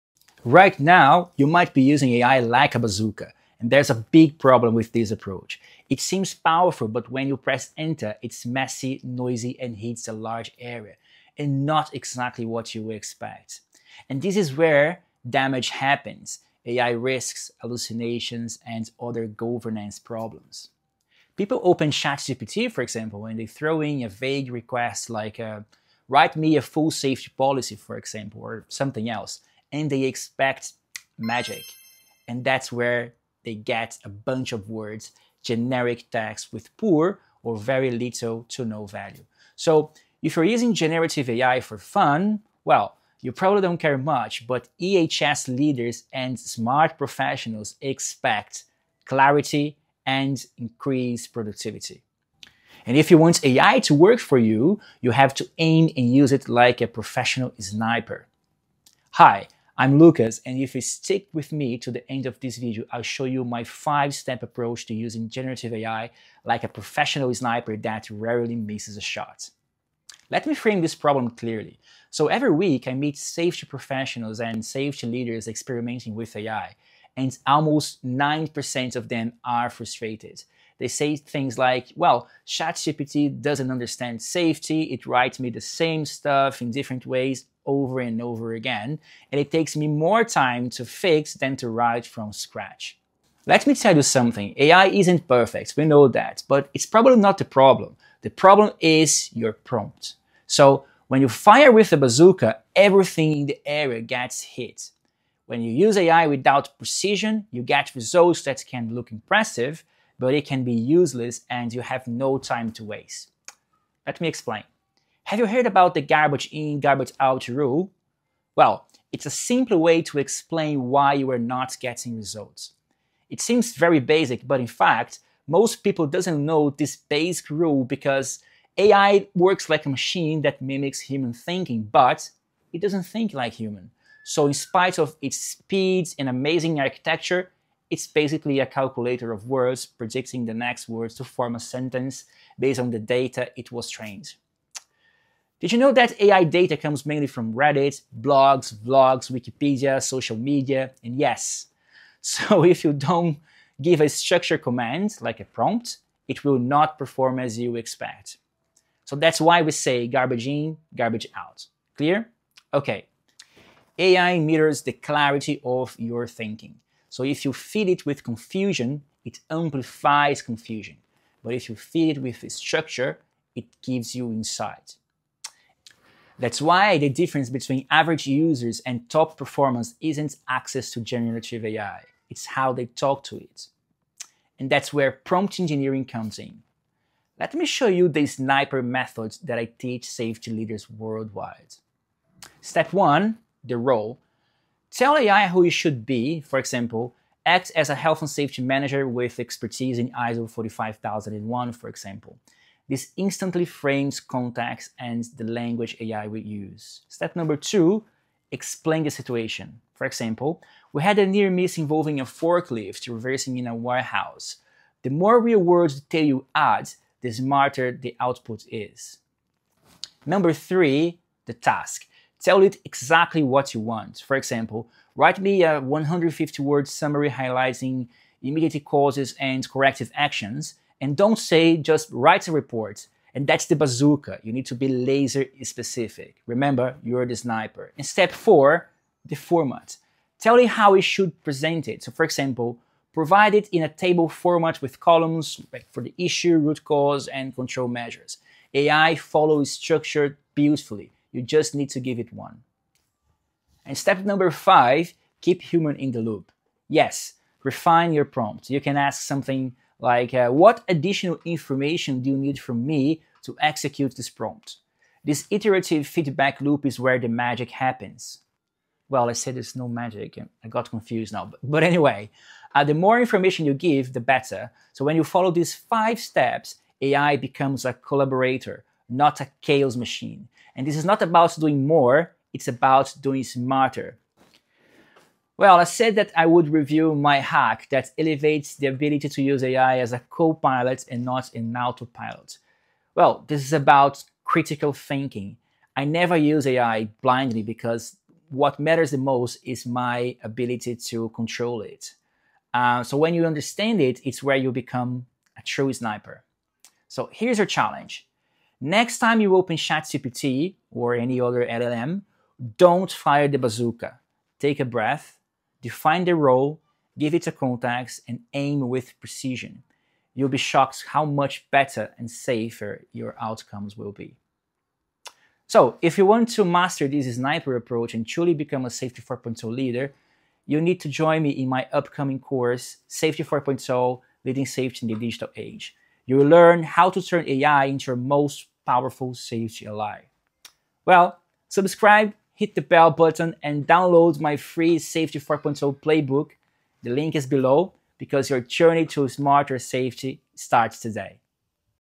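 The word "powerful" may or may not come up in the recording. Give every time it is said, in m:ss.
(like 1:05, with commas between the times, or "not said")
0:06, 5:38.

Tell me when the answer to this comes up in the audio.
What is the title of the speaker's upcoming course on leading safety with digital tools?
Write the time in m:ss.
5:33.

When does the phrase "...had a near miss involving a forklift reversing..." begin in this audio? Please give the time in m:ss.
3:31.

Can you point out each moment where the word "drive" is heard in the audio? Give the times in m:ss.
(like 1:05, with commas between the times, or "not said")
not said.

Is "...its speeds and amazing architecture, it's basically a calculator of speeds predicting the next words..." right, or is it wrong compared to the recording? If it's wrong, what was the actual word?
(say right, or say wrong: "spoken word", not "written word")
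wrong: "words", not "speeds".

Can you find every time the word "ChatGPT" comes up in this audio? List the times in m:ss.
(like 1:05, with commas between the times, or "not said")
0:21, 1:22, 5:09.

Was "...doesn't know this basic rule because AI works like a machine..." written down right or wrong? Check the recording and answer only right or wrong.
right.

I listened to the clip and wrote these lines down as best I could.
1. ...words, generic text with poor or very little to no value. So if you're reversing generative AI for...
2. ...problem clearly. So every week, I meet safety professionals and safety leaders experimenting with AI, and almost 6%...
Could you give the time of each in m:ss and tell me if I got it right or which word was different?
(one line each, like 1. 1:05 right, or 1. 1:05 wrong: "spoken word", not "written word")
1. 0:34 wrong: "using", not "reversing"
2. 1:10 wrong: "9", not "6".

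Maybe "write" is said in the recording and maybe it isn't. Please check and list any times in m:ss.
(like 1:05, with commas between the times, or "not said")
0:26, 1:25, 1:31, 3:45, 3:52.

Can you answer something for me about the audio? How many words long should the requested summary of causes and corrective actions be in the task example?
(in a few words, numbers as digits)
150.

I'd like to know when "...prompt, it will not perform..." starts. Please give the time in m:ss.
2:35.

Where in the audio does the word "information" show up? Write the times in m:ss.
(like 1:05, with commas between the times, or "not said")
4:21, 4:33.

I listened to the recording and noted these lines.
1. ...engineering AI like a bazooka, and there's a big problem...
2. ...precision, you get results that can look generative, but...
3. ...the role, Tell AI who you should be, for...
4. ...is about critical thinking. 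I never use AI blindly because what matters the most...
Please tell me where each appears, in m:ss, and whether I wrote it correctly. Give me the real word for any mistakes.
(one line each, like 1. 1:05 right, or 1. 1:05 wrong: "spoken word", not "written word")
1. 0:01 wrong: "using", not "engineering"
2. 1:46 wrong: "impressive", not "generative"
3. 3:13 right
4. 4:53 right.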